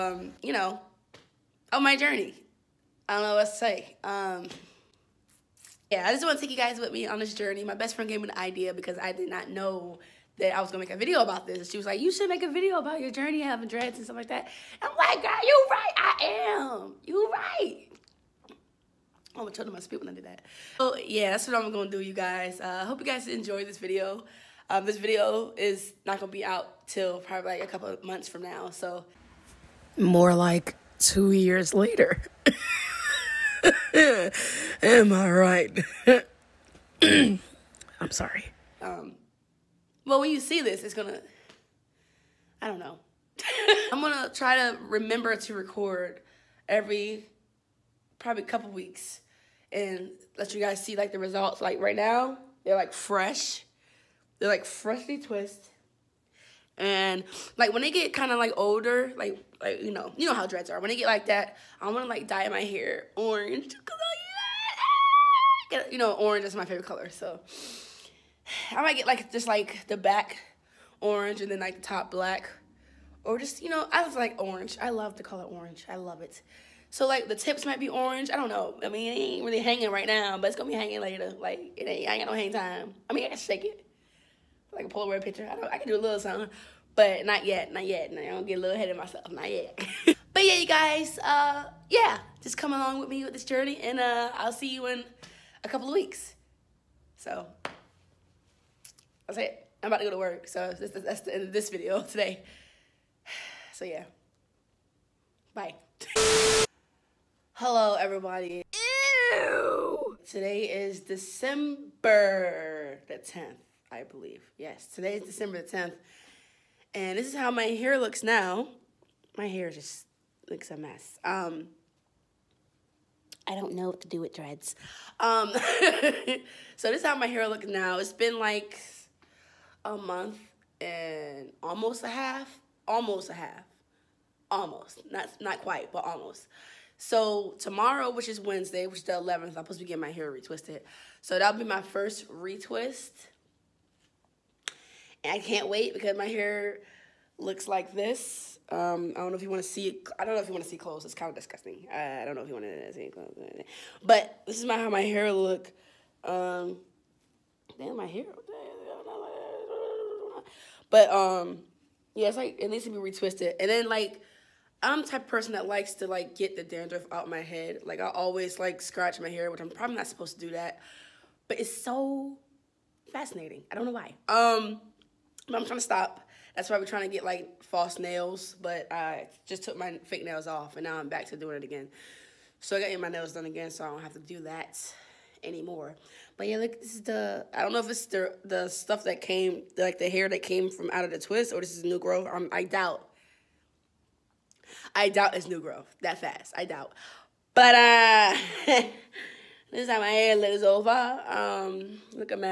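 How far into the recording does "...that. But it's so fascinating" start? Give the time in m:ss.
2:50.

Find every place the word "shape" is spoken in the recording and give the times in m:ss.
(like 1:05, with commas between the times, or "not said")
not said.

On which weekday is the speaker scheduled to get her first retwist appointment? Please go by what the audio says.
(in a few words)
Wednesday.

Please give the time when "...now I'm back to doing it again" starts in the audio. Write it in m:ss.
3:00.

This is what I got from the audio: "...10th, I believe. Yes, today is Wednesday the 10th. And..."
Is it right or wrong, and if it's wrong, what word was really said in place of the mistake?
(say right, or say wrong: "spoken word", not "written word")
wrong: "December", not "Wednesday".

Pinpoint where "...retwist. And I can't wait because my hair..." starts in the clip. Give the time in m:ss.
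2:22.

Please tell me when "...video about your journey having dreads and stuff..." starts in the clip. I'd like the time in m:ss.
0:12.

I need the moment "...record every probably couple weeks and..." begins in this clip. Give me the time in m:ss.
0:45.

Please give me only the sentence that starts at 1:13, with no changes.
Or just, you know, I was like orange.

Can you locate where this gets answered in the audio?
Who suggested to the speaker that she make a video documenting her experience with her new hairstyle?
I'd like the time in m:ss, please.
0:07.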